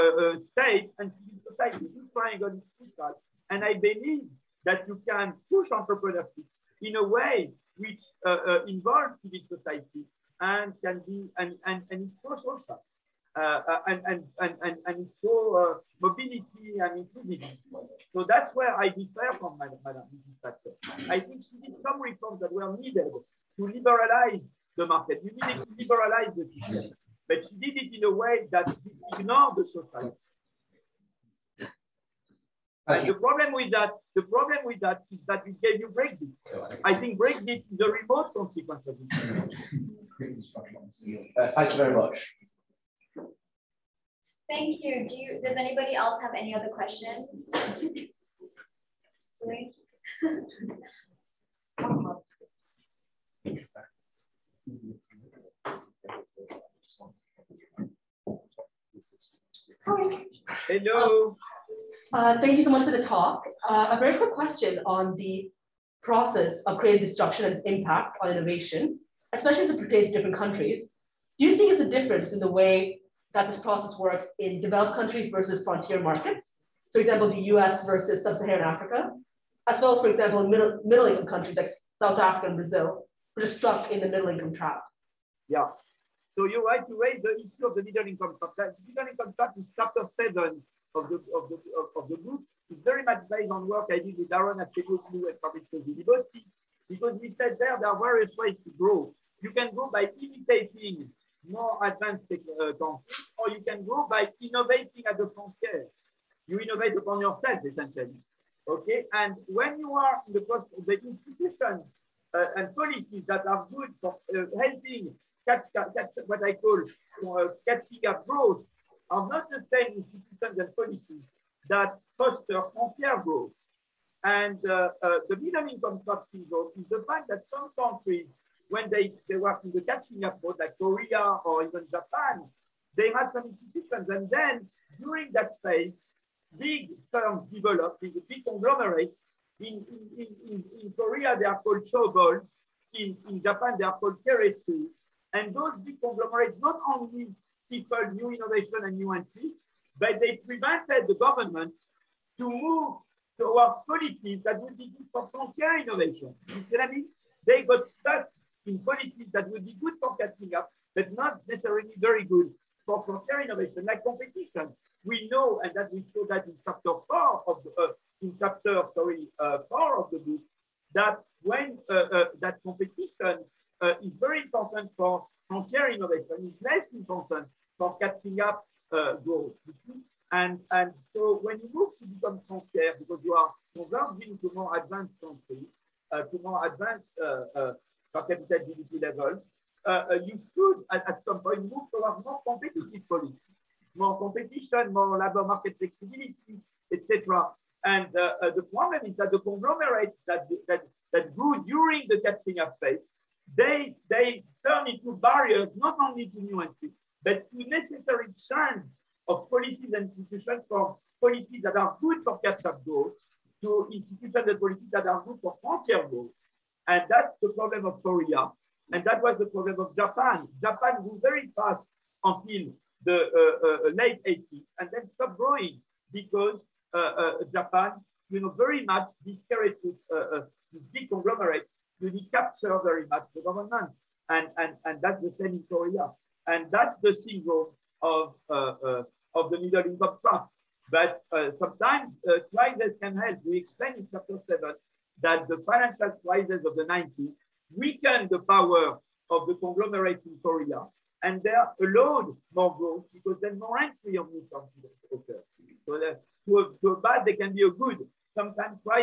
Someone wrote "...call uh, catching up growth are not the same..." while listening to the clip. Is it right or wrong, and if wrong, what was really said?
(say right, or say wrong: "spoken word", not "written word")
right.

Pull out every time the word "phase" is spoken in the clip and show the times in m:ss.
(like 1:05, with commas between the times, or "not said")
2:15, 3:22.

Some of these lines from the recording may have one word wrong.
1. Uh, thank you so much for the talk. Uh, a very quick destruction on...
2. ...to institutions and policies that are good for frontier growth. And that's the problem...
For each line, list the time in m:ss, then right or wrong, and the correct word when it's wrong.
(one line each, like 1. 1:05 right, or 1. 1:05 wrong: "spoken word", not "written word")
1. 1:02 wrong: "question", not "destruction"
2. 3:33 right.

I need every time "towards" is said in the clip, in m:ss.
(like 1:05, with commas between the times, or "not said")
2:33, 3:11.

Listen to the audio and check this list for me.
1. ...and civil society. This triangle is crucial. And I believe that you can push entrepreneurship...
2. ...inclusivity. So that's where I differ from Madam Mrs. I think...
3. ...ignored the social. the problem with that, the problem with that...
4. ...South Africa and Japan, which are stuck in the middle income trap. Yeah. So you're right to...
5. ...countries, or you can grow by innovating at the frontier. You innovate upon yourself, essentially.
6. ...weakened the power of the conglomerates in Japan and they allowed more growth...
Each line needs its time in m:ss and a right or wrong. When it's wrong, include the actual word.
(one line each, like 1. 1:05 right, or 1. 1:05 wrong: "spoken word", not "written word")
1. 0:00 right
2. 0:17 right
3. 0:29 right
4. 1:22 wrong: "Brazil", not "Japan"
5. 1:42 right
6. 4:07 wrong: "Korea", not "Japan".